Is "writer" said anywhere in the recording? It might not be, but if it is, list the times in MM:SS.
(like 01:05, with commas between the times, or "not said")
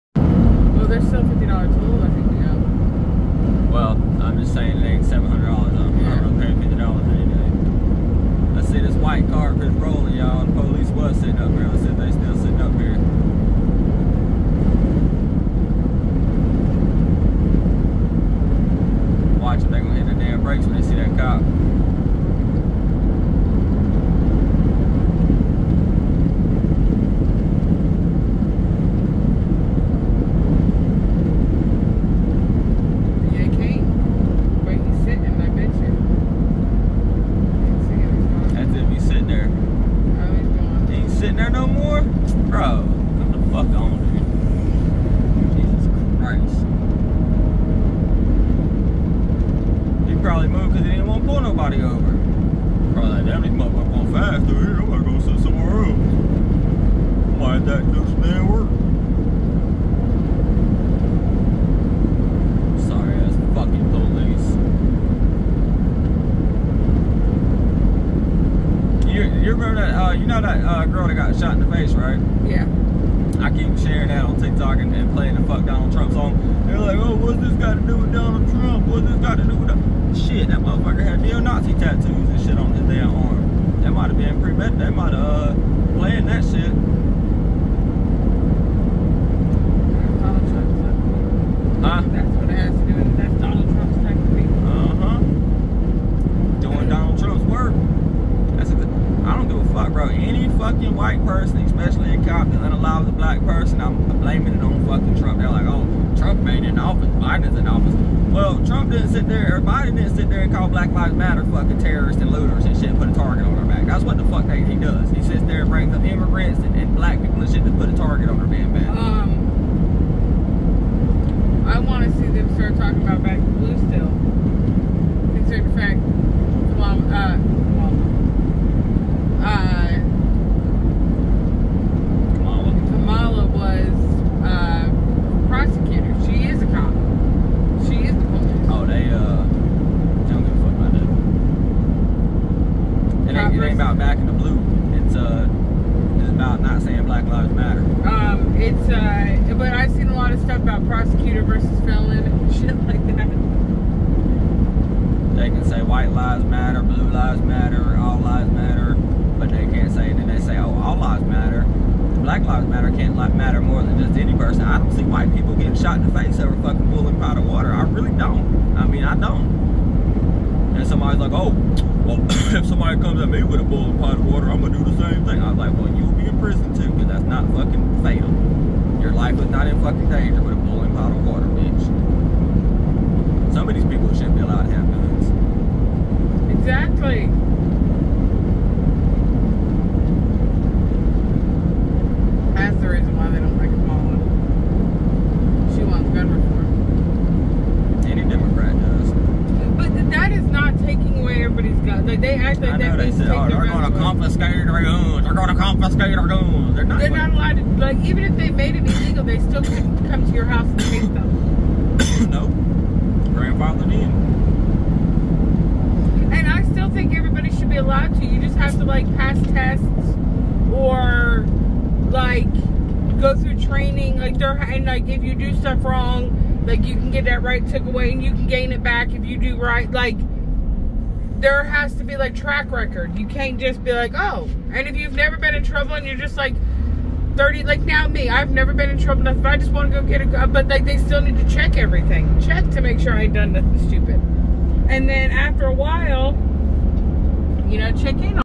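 not said.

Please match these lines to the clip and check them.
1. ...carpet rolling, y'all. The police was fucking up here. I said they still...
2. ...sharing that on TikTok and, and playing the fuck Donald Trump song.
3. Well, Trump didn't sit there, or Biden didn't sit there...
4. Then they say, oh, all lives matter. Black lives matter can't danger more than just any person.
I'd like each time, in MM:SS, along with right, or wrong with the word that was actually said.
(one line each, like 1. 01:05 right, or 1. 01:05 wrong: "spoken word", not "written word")
1. 00:09 wrong: "sitting", not "fucking"
2. 01:13 right
3. 01:48 right
4. 02:40 wrong: "matter", not "danger".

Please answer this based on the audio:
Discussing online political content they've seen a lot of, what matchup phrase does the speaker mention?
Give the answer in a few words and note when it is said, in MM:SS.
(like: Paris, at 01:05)
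prosecutor versus felon, at 02:30.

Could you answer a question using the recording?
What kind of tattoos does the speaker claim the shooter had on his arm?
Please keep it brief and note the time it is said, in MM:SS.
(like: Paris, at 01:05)
neo-Nazi, at 01:21.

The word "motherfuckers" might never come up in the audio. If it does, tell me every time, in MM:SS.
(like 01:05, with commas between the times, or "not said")
00:53, 01:20.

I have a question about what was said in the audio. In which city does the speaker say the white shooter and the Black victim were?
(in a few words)
Compton.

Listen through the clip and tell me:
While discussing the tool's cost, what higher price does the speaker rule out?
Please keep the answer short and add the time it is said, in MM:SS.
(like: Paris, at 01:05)
$700, at 00:05.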